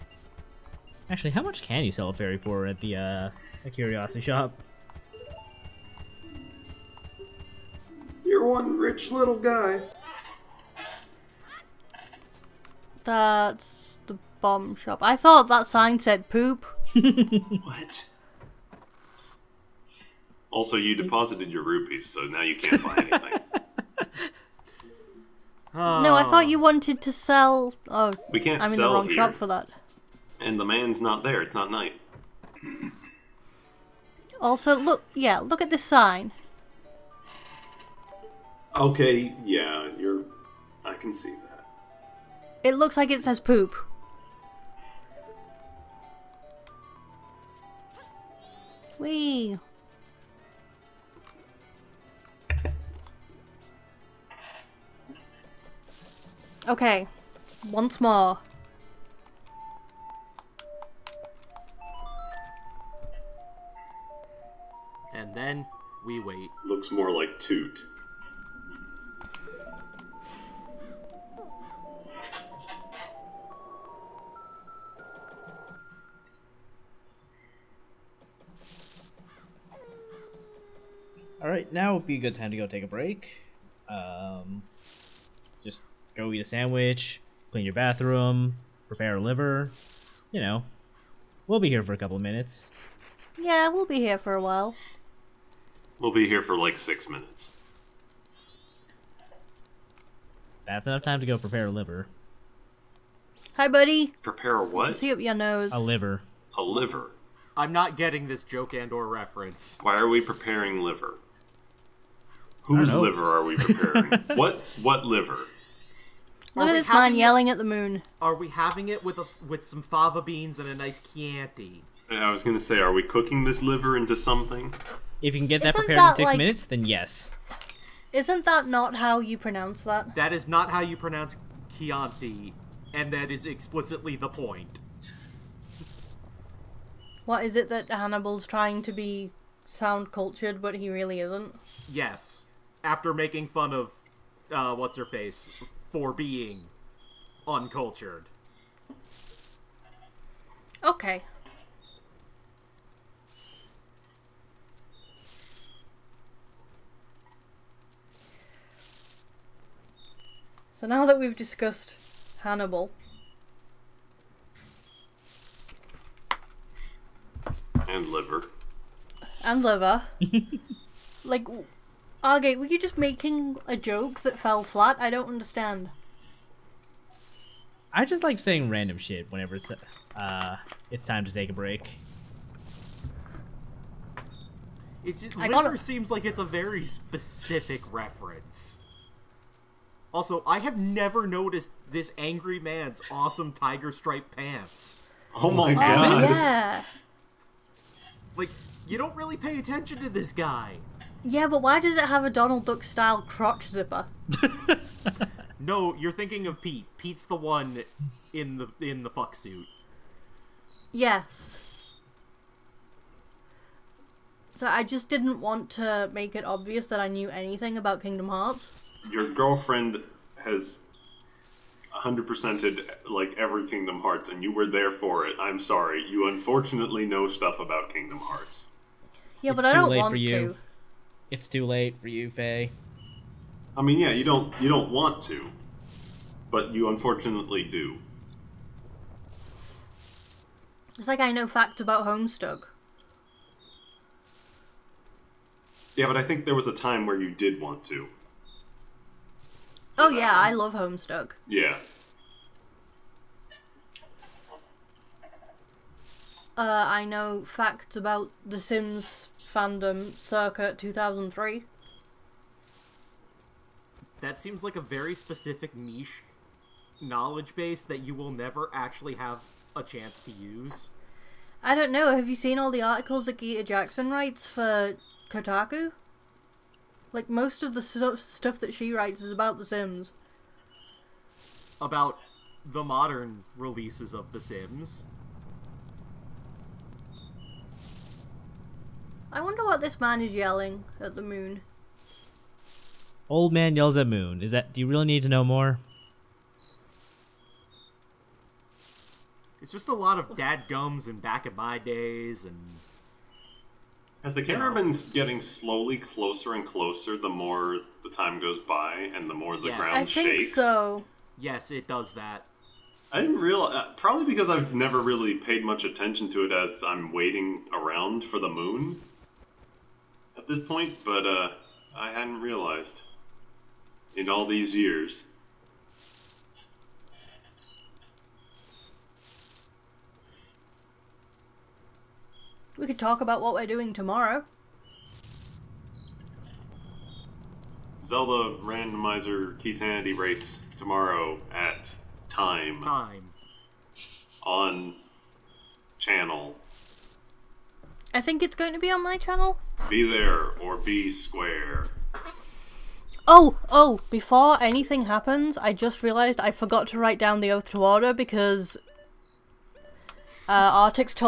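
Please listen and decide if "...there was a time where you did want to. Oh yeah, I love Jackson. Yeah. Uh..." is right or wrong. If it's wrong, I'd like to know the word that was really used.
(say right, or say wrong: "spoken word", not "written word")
wrong: "Homestuck", not "Jackson".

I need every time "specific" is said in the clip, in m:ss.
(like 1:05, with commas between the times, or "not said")
3:06, 4:25.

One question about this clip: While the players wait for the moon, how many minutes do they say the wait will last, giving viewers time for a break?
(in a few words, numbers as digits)
6.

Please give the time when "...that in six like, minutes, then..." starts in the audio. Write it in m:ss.
2:05.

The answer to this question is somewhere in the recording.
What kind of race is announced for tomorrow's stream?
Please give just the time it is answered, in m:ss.
5:38.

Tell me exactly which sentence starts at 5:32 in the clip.
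We could talk about what we're doing tomorrow.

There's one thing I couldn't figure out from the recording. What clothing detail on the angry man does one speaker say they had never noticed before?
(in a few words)
tiger stripe pants.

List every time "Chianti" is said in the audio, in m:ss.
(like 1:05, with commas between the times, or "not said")
2:01, 2:11.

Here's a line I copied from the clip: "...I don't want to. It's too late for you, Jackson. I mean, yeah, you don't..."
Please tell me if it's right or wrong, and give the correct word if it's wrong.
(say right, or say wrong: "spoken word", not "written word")
wrong: "Faye", not "Jackson".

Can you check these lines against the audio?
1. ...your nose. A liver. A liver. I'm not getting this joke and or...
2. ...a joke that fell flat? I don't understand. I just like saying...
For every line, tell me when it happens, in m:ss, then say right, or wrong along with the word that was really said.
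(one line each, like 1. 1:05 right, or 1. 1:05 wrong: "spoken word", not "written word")
1. 1:45 right
2. 2:53 right.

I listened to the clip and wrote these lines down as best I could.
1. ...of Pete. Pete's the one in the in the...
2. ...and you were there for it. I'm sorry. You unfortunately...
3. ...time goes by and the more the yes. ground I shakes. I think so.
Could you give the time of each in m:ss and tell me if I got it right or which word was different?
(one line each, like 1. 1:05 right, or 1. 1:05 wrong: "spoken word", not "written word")
1. 3:26 right
2. 3:44 right
3. 5:08 right.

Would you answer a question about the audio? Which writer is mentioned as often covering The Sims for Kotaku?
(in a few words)
Gita Jackson.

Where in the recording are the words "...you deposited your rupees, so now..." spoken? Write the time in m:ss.
0:20.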